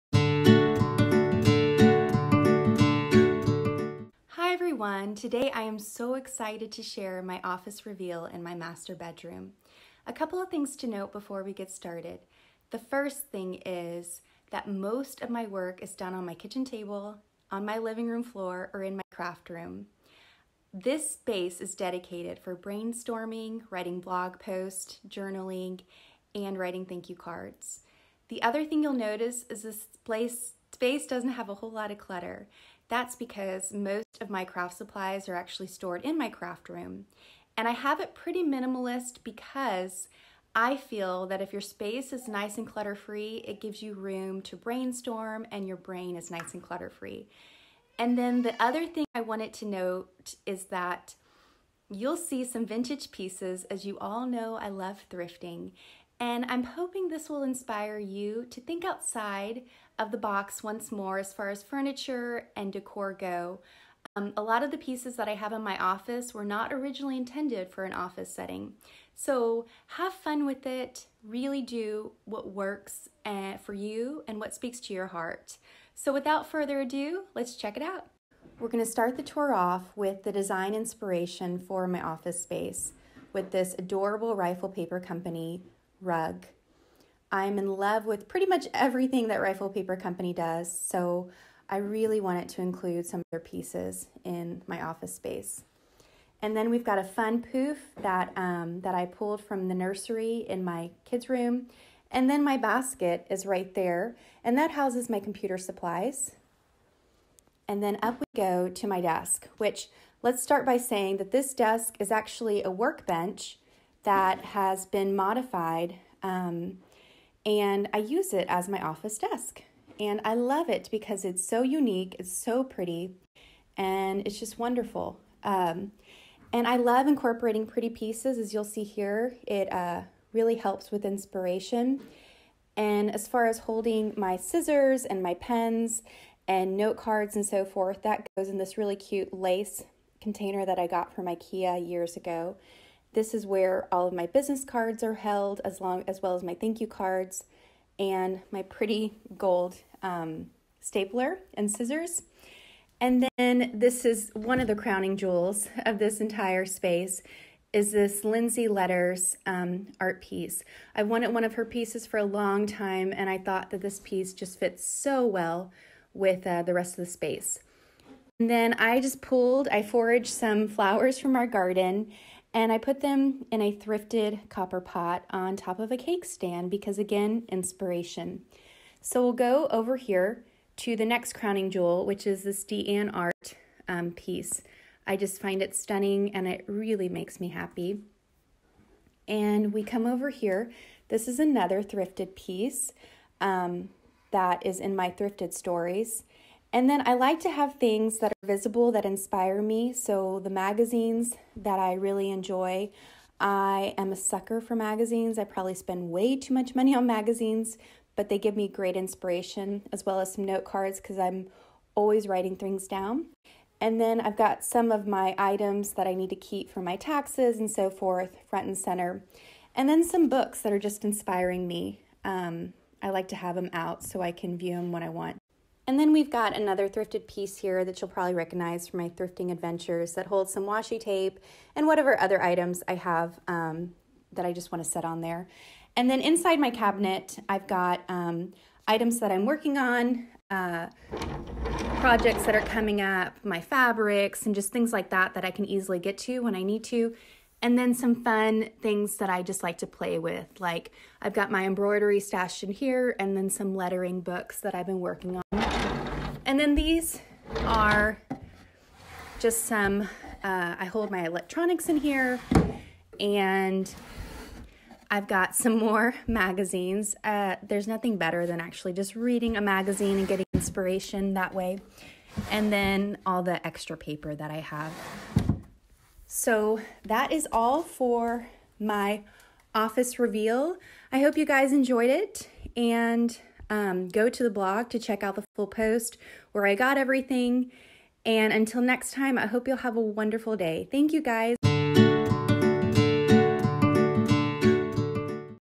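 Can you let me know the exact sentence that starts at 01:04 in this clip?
Um, a lot of the pieces that I have in my office were not originally intended for an office setting.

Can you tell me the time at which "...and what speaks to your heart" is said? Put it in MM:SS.
01:14.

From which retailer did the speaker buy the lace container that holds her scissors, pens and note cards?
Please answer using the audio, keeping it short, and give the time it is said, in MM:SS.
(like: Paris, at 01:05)
IKEA, at 02:21.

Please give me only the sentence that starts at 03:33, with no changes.
And then I've got some of my items that I need to keep for my taxes and so forth, front and center.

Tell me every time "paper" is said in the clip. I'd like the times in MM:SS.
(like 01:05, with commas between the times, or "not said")
01:24, 01:29, 04:33.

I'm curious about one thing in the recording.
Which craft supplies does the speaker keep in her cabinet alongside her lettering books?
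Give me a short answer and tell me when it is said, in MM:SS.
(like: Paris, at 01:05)
embroidery, at 04:11.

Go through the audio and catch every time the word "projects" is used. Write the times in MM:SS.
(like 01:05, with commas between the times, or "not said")
04:01.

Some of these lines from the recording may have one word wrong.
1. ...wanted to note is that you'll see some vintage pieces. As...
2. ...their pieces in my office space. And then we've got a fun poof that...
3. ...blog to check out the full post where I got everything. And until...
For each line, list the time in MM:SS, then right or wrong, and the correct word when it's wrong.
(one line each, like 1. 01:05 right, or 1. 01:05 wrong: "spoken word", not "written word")
1. 00:49 right
2. 01:33 right
3. 04:44 right.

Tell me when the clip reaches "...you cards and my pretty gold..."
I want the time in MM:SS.
02:26.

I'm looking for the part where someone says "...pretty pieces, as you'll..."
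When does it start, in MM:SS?
02:07.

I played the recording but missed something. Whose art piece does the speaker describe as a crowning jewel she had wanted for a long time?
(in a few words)
Lindsay Letters.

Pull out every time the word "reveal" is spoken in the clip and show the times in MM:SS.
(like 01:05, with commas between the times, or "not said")
00:07, 04:40.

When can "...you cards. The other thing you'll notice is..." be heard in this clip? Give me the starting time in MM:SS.
00:27.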